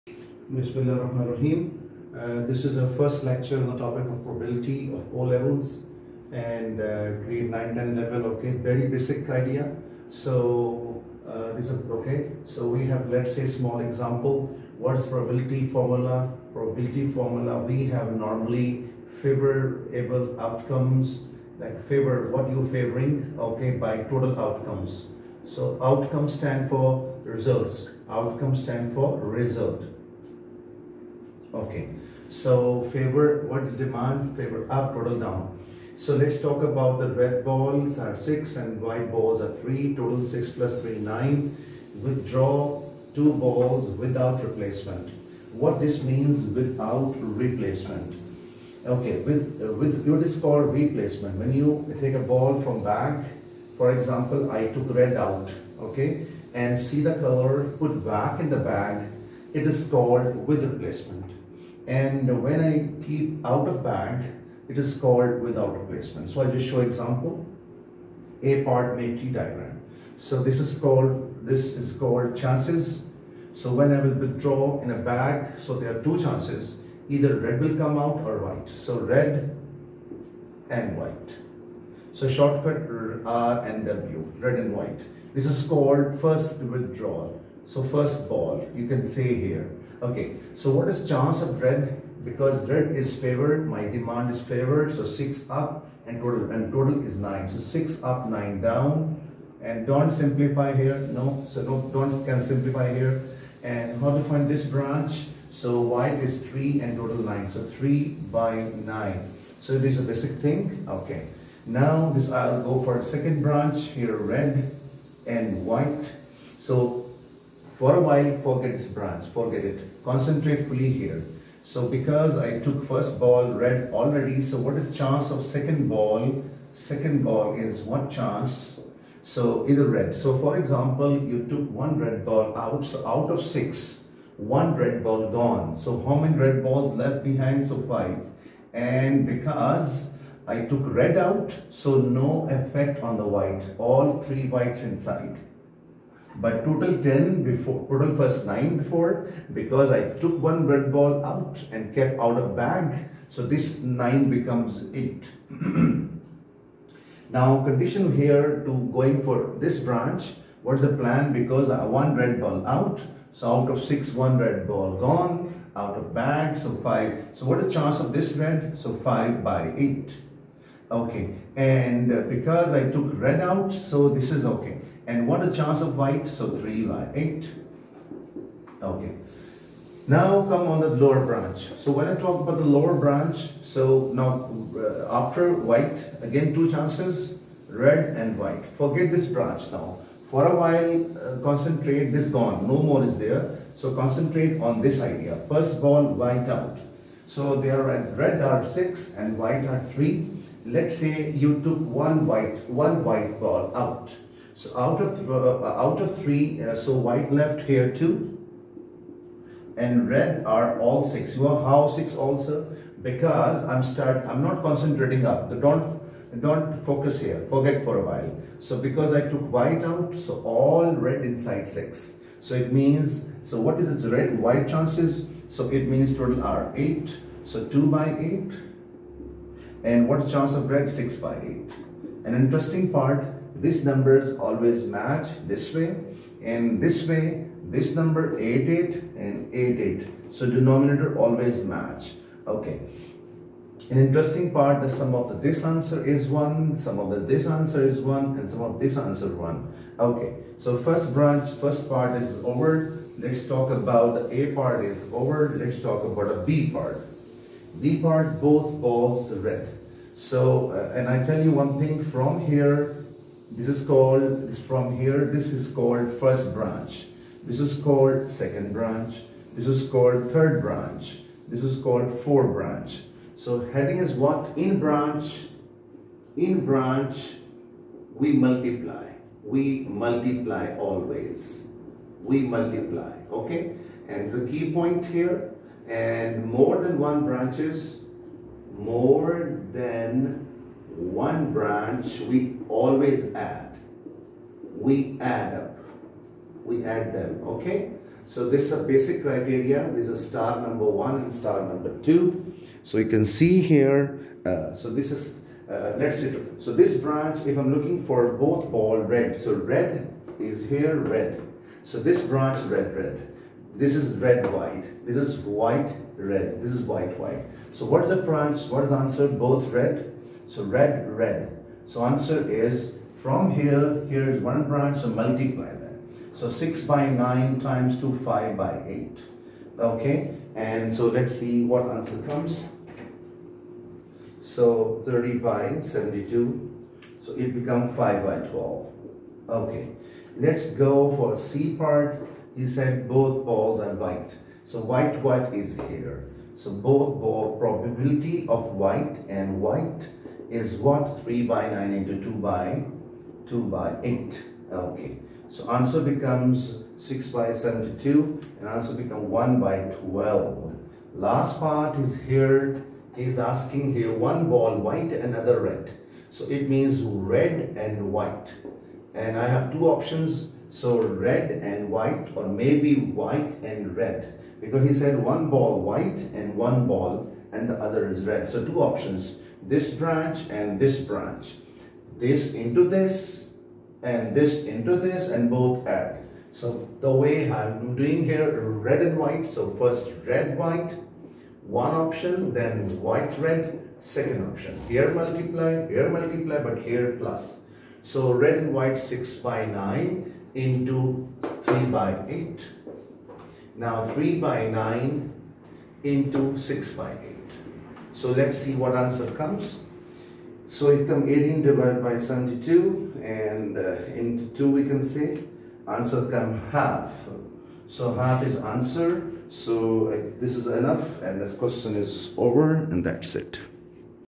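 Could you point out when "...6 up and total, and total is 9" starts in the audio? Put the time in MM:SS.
01:35.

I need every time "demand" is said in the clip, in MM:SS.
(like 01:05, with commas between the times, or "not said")
00:33, 01:33.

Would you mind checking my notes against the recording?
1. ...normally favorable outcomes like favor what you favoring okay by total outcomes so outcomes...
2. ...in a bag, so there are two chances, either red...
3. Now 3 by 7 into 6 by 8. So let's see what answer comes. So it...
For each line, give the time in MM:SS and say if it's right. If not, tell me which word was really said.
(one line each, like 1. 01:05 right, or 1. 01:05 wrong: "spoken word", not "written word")
1. 00:18 right
2. 01:14 right
3. 06:43 wrong: "9", not "7".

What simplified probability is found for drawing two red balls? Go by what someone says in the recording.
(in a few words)
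5/12.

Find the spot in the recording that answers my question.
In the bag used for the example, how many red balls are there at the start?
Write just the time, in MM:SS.
00:37.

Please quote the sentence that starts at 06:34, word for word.
Here multiply, here multiply, but here plus.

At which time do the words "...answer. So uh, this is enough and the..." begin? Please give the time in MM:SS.
06:58.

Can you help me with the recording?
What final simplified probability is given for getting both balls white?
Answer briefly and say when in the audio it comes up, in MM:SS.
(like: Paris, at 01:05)
1/12, at 05:59.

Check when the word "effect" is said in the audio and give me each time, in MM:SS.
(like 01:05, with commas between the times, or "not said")
02:22.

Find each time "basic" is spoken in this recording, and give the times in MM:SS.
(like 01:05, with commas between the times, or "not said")
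00:08, 01:50, 04:58.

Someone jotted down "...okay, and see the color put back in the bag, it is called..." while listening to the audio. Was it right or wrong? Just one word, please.
right.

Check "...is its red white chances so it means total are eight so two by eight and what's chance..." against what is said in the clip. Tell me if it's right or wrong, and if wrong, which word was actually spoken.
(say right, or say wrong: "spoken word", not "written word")
right.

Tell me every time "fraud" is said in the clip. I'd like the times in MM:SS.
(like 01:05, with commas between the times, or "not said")
not said.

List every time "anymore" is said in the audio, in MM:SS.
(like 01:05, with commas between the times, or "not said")
not said.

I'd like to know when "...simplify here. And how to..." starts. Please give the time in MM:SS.
01:42.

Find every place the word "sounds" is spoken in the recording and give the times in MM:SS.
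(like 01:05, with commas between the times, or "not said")
not said.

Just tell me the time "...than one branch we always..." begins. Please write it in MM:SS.
04:49.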